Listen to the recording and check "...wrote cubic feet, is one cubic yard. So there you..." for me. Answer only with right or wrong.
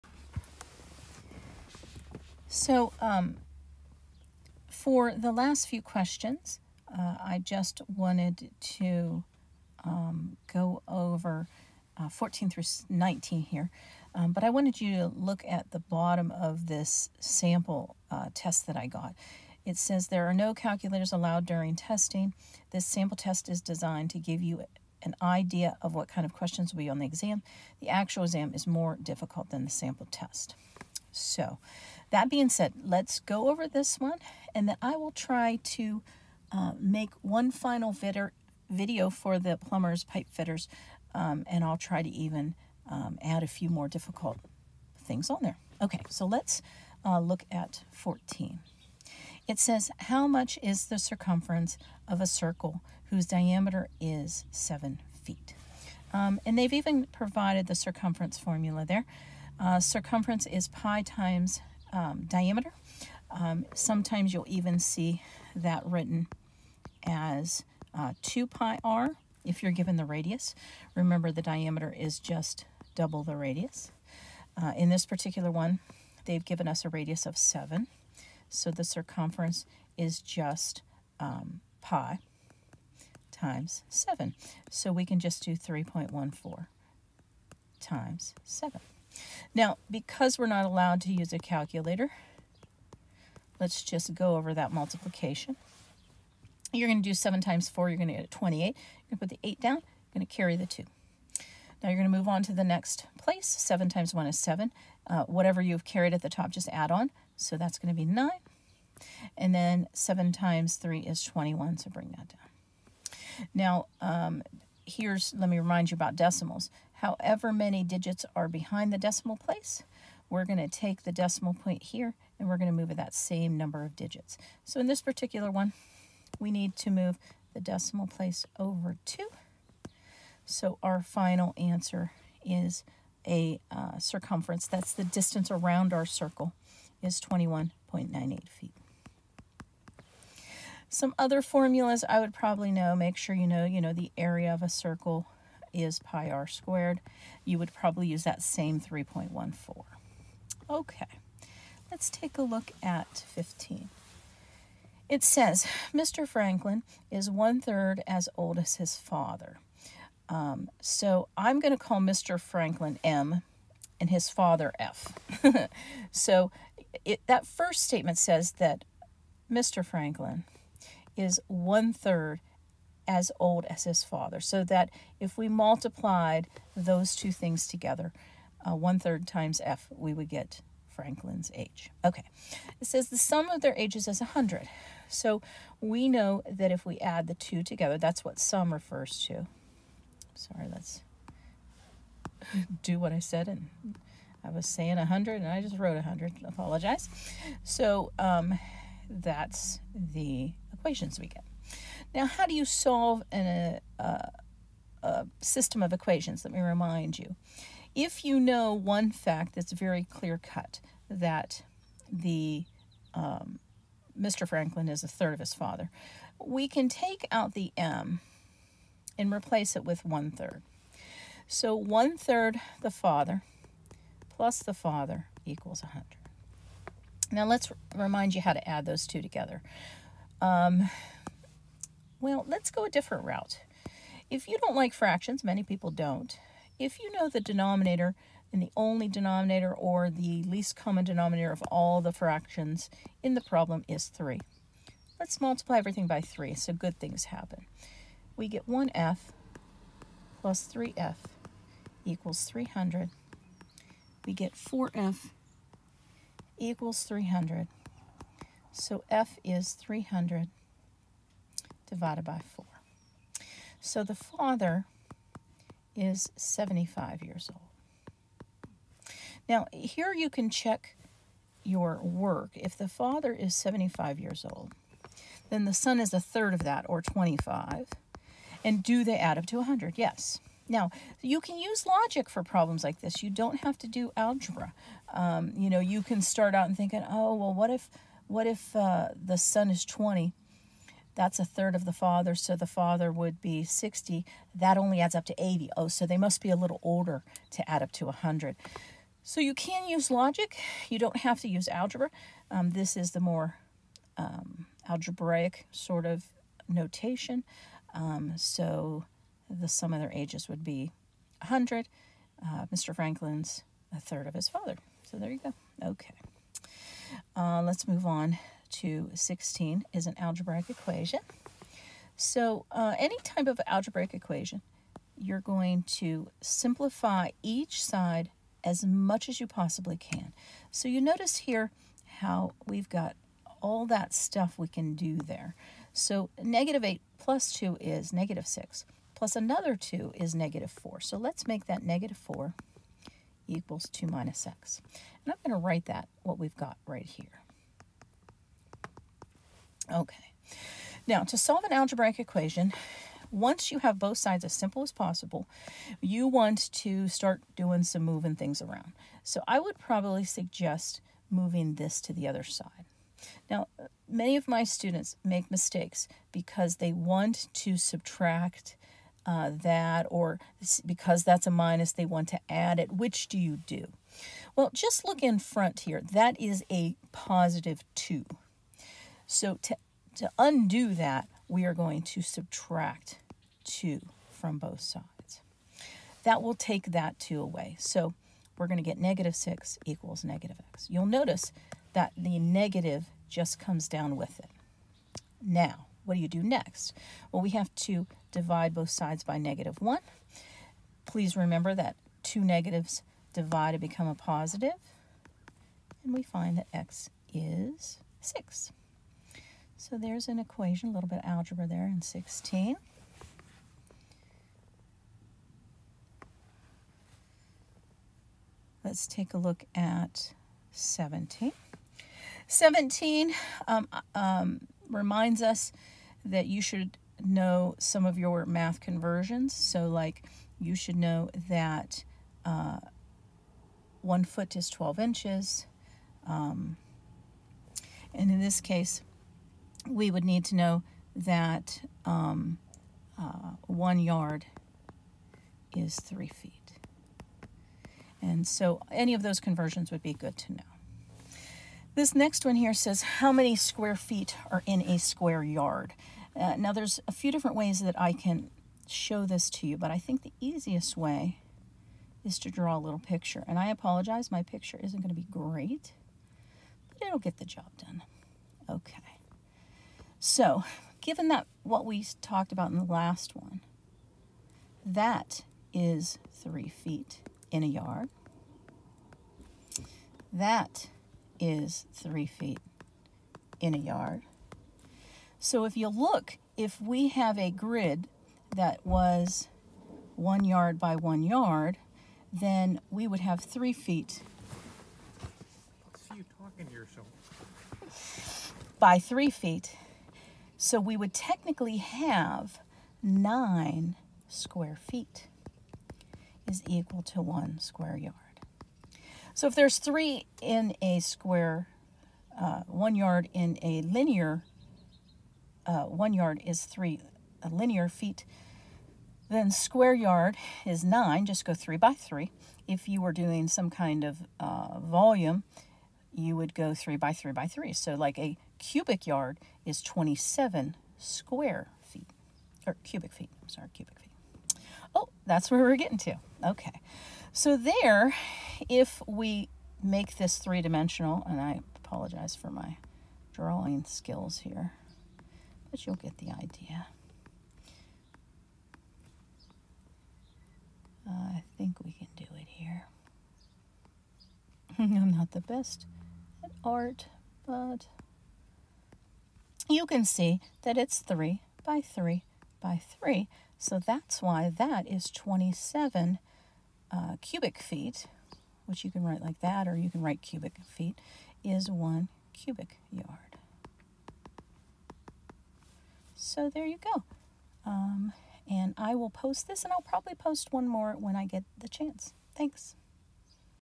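wrong.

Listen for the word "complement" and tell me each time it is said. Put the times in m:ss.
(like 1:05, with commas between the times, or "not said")
not said.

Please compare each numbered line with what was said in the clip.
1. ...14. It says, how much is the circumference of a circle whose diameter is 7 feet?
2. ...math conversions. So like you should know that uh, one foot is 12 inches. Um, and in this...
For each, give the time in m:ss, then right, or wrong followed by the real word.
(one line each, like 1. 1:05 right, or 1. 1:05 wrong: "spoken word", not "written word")
1. 0:47 right
2. 7:08 right.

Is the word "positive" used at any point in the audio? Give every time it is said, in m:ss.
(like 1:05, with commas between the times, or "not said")
6:17, 6:44.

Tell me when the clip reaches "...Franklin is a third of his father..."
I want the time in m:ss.
3:34.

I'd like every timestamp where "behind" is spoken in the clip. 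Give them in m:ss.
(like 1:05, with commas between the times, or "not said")
1:58.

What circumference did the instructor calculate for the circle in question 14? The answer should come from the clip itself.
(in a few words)
21.98 feet.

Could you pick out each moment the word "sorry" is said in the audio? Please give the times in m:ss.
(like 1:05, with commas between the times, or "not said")
3:10, 8:53.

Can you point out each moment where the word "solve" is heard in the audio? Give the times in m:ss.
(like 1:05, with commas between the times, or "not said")
3:22, 5:51.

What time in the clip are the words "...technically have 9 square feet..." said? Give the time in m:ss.
8:21.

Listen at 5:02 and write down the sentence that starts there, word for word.
Um, this is the more um, algebraic sort of notation.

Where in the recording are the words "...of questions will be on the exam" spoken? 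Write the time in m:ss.
0:26.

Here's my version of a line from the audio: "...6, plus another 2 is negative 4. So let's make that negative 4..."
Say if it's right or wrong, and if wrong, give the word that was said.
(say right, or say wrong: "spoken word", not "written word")
right.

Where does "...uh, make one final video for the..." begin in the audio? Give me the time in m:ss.
0:36.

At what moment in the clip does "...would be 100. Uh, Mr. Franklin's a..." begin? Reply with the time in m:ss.
5:10.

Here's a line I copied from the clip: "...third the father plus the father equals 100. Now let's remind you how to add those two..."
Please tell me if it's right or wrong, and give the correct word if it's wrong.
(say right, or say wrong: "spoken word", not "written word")
right.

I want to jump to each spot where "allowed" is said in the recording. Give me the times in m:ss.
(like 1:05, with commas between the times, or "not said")
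0:21, 1:30.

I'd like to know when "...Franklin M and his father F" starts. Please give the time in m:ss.
2:42.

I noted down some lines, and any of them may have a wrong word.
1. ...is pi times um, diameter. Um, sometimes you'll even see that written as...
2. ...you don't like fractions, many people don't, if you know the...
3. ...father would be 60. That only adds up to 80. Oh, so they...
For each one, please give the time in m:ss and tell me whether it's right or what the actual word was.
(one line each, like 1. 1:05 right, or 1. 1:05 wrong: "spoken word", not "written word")
1. 1:00 right
2. 3:54 right
3. 4:52 right.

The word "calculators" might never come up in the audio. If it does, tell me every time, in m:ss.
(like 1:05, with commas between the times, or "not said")
0:20, 1:31.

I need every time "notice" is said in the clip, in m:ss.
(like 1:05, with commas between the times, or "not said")
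5:31, 6:31.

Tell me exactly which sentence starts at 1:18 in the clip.
So the circumference is just um, pi times 7.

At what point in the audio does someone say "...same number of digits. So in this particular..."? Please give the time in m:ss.
2:03.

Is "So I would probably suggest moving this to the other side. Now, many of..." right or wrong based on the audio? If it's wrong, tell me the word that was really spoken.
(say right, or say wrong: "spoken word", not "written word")
right.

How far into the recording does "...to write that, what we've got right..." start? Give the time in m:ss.
5:45.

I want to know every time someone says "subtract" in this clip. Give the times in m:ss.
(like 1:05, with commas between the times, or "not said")
6:07, 6:22.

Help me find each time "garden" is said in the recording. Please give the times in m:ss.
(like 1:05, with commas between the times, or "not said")
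not said.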